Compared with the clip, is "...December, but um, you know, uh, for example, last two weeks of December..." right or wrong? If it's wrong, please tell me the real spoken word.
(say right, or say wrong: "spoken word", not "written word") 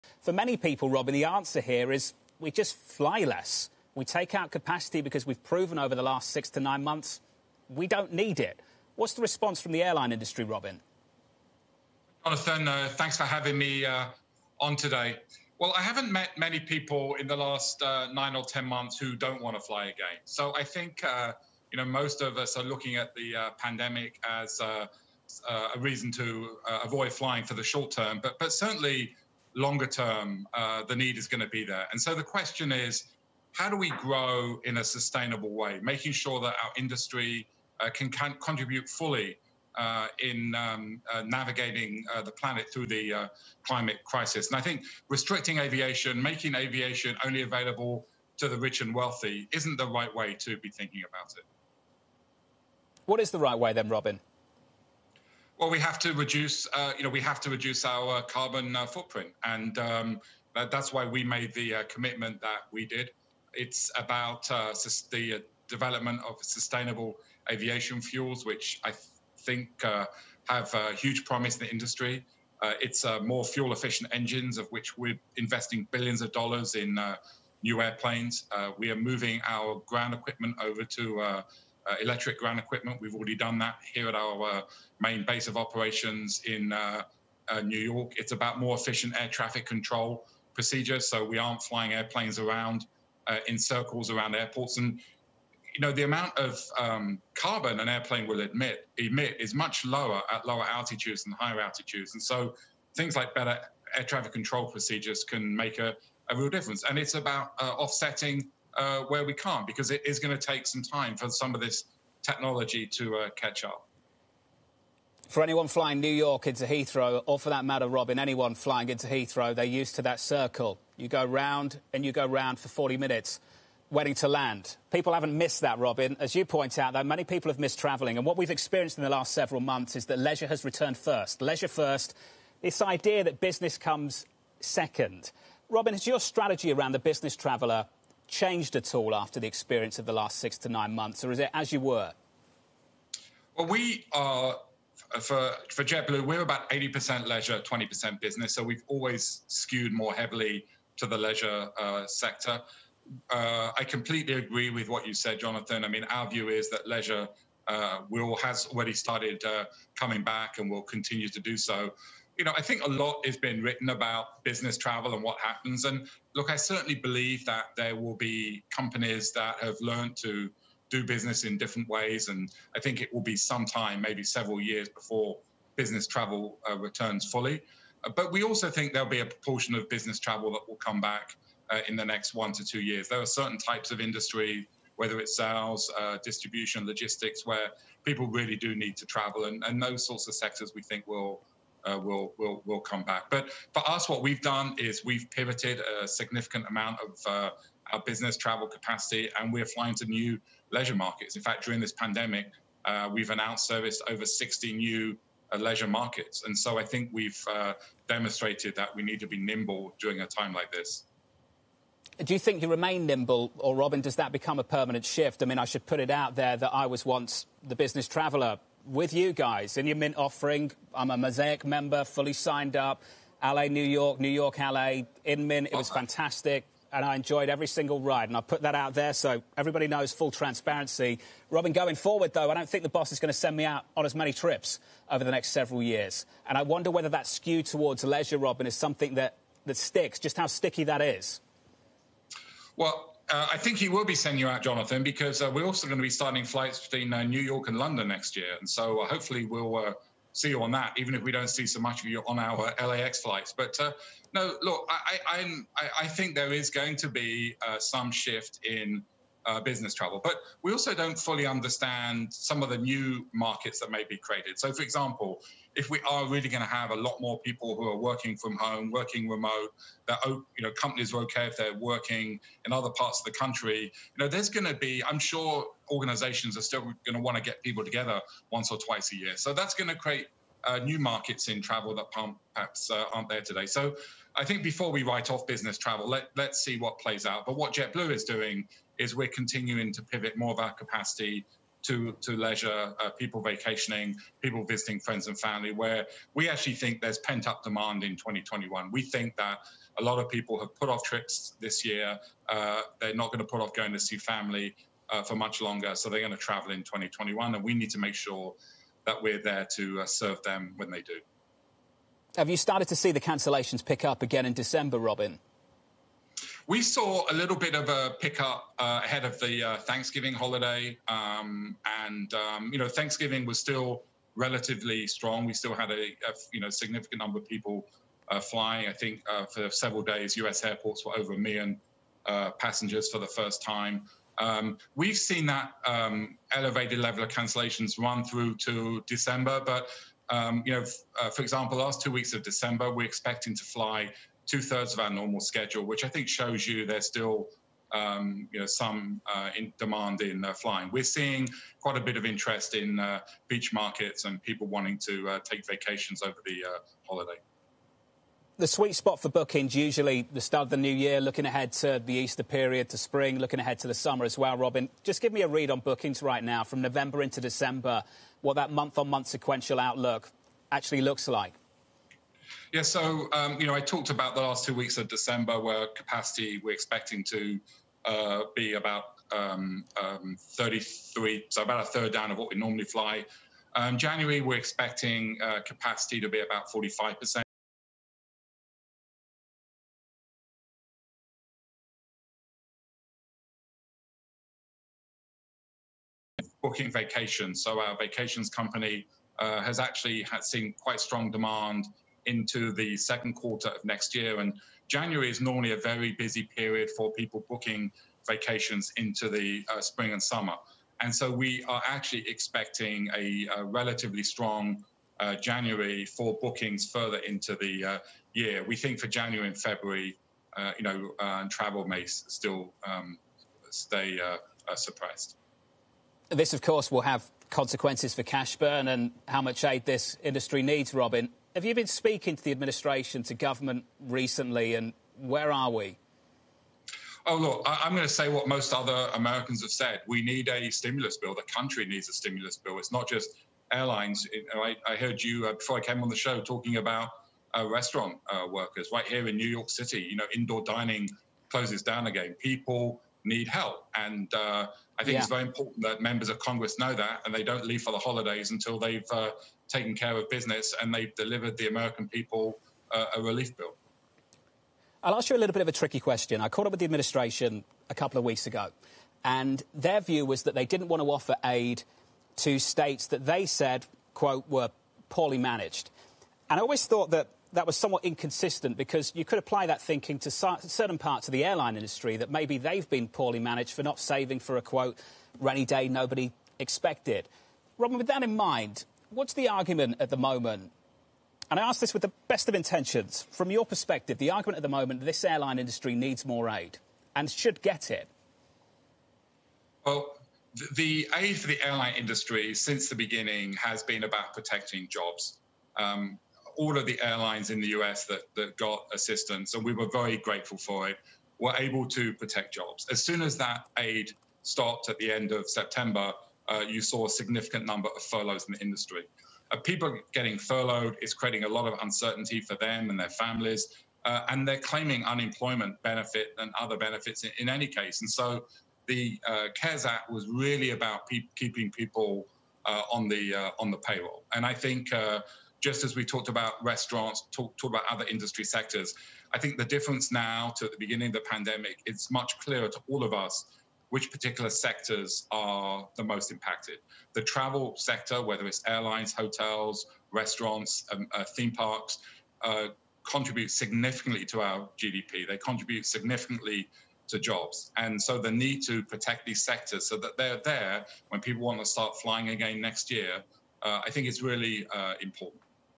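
right.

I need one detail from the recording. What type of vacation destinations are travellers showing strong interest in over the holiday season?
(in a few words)
beach markets.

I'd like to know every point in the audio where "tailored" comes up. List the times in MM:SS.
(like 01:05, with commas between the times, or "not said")
not said.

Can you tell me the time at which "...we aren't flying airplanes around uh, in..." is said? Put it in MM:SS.
01:31.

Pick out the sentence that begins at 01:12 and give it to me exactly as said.
it's more fuel efficient engines, of which we're investing billions of dollars in new airplanes.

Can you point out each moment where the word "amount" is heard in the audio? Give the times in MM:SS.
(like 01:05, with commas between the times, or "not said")
01:36, 03:16.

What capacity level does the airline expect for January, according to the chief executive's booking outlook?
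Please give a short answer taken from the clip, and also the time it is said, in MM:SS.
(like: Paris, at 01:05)
45%, at 06:26.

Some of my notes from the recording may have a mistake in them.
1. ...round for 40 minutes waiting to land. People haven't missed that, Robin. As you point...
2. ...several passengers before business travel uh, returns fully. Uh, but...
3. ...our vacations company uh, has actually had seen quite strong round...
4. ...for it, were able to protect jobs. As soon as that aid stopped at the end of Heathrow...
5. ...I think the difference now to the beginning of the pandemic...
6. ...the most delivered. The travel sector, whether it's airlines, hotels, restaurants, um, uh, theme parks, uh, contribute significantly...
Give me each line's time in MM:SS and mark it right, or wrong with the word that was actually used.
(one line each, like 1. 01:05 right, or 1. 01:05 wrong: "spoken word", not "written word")
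1. 02:02 right
2. 02:54 wrong: "years", not "passengers"
3. 06:37 wrong: "demand", not "round"
4. 08:30 wrong: "September", not "Heathrow"
5. 08:59 right
6. 09:05 wrong: "impacted", not "delivered".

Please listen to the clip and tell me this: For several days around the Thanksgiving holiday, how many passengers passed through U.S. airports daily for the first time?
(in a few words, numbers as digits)
over a million.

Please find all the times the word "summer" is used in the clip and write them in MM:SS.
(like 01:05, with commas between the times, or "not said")
06:03, 06:50.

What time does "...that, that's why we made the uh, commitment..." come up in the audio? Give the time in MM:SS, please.
01:00.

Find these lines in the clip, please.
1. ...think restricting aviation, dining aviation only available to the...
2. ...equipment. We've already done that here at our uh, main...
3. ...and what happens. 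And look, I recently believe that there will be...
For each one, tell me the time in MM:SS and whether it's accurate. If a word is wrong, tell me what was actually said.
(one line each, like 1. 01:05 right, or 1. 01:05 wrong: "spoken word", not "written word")
1. 00:44 wrong: "making", not "dining"
2. 01:22 right
3. 02:45 wrong: "certainly", not "recently".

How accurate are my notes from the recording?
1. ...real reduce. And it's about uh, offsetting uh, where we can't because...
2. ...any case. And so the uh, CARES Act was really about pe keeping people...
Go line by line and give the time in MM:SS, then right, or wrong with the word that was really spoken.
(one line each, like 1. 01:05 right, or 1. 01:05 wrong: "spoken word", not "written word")
1. 01:46 wrong: "difference", not "reduce"
2. 08:47 right.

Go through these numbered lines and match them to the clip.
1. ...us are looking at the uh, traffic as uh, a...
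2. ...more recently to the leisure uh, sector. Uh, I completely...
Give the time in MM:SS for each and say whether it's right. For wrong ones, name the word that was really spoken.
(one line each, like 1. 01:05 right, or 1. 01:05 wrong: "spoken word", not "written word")
1. 00:22 wrong: "pandemic", not "traffic"
2. 02:29 wrong: "heavily", not "recently".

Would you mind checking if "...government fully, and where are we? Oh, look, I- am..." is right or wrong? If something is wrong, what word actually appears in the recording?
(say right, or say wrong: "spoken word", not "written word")
wrong: "recently", not "fully".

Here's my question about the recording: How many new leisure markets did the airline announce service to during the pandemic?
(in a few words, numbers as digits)
over 60.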